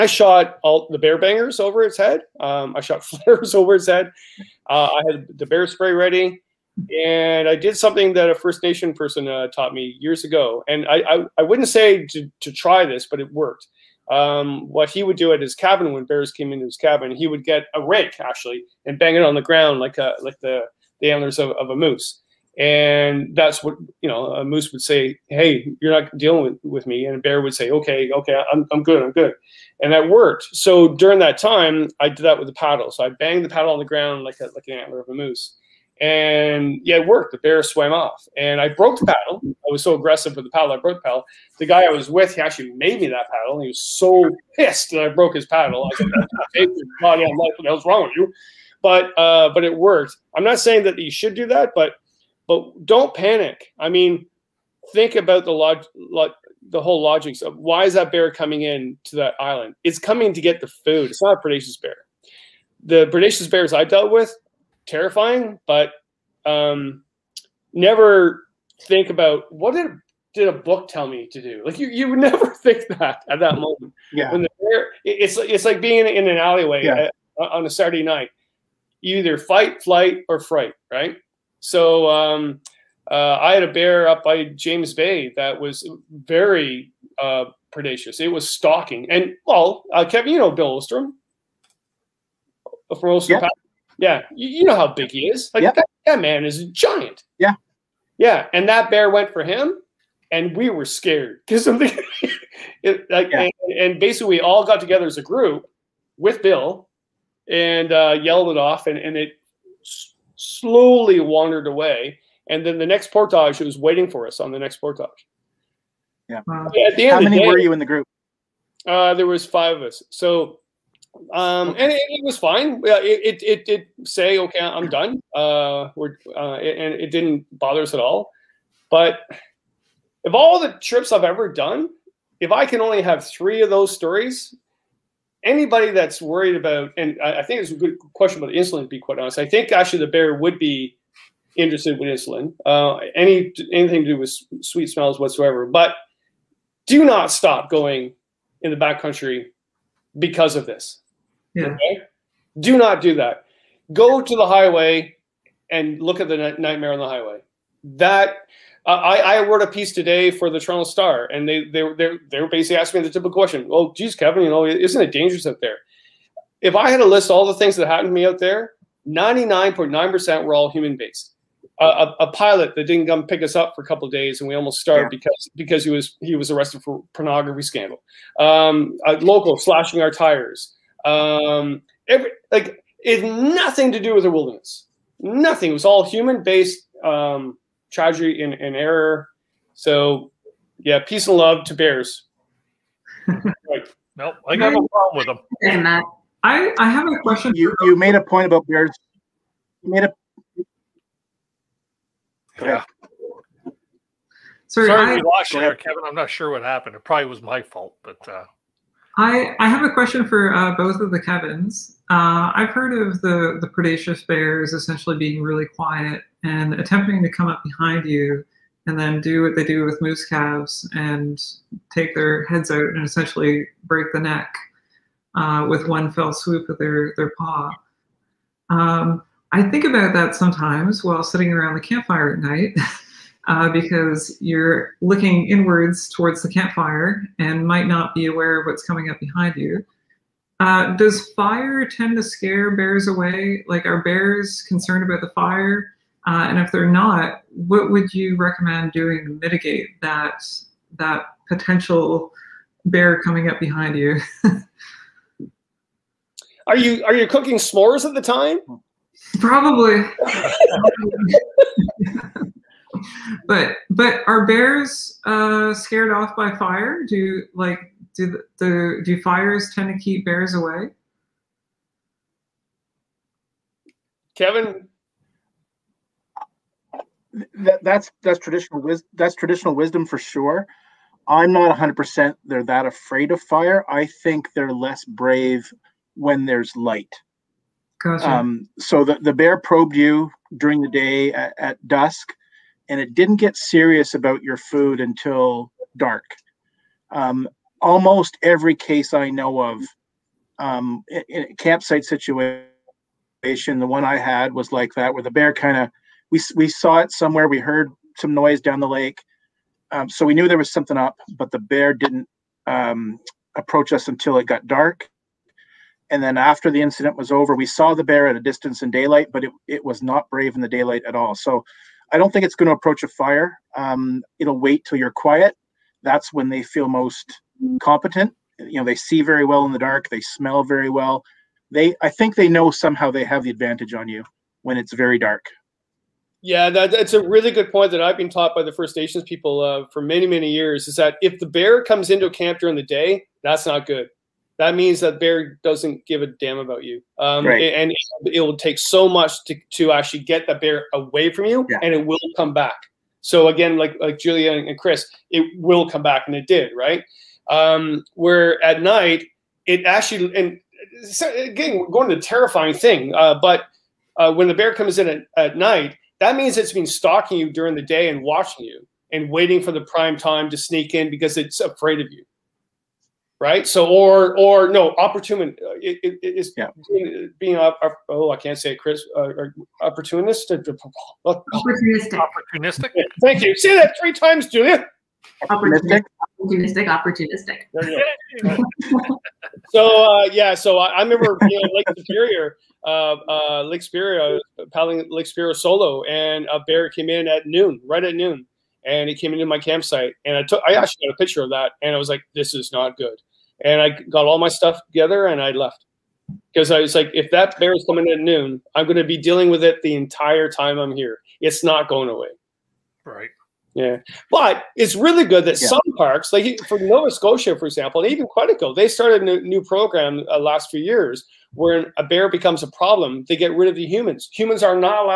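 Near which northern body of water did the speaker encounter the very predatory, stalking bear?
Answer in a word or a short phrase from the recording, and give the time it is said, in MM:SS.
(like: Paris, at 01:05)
James Bay, at 01:24.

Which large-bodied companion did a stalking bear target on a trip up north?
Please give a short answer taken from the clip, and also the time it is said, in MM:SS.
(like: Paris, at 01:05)
Bill Ostrom, at 01:30.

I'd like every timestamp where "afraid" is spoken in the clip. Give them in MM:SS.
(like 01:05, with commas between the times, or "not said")
04:42, 06:11.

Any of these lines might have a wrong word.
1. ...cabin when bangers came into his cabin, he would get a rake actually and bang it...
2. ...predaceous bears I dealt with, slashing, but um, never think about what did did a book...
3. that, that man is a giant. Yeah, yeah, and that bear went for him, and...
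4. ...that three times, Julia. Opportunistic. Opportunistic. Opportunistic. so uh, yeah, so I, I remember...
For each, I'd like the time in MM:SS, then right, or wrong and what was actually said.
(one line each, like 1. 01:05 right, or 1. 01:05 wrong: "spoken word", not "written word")
1. 00:15 wrong: "bears", not "bangers"
2. 01:03 wrong: "terrifying", not "slashing"
3. 01:35 right
4. 06:23 right.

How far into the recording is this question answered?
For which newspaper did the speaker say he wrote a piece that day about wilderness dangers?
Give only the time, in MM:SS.
02:40.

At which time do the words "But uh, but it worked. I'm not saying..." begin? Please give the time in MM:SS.
00:48.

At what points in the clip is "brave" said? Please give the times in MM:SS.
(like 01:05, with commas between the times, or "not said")
04:45, 05:20.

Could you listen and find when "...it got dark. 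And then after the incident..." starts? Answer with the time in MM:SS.
05:14.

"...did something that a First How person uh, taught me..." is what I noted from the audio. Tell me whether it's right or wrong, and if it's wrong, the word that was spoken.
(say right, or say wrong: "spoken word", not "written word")
wrong: "Nation", not "How".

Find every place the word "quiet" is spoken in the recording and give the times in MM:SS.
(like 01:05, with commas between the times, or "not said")
03:35, 05:25.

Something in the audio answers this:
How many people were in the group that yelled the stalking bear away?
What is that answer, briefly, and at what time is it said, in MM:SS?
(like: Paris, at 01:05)
5, at 01:59.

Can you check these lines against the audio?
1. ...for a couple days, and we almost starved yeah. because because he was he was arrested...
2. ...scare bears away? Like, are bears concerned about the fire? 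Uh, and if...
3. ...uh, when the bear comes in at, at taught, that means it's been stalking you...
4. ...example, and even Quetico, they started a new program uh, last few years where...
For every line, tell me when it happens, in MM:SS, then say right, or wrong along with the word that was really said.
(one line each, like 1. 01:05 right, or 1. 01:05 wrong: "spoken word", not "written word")
1. 02:53 right
2. 04:02 right
3. 06:04 wrong: "night", not "taught"
4. 06:57 right.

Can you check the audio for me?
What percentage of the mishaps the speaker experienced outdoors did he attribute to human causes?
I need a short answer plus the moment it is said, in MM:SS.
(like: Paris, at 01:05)
99.9%, at 02:49.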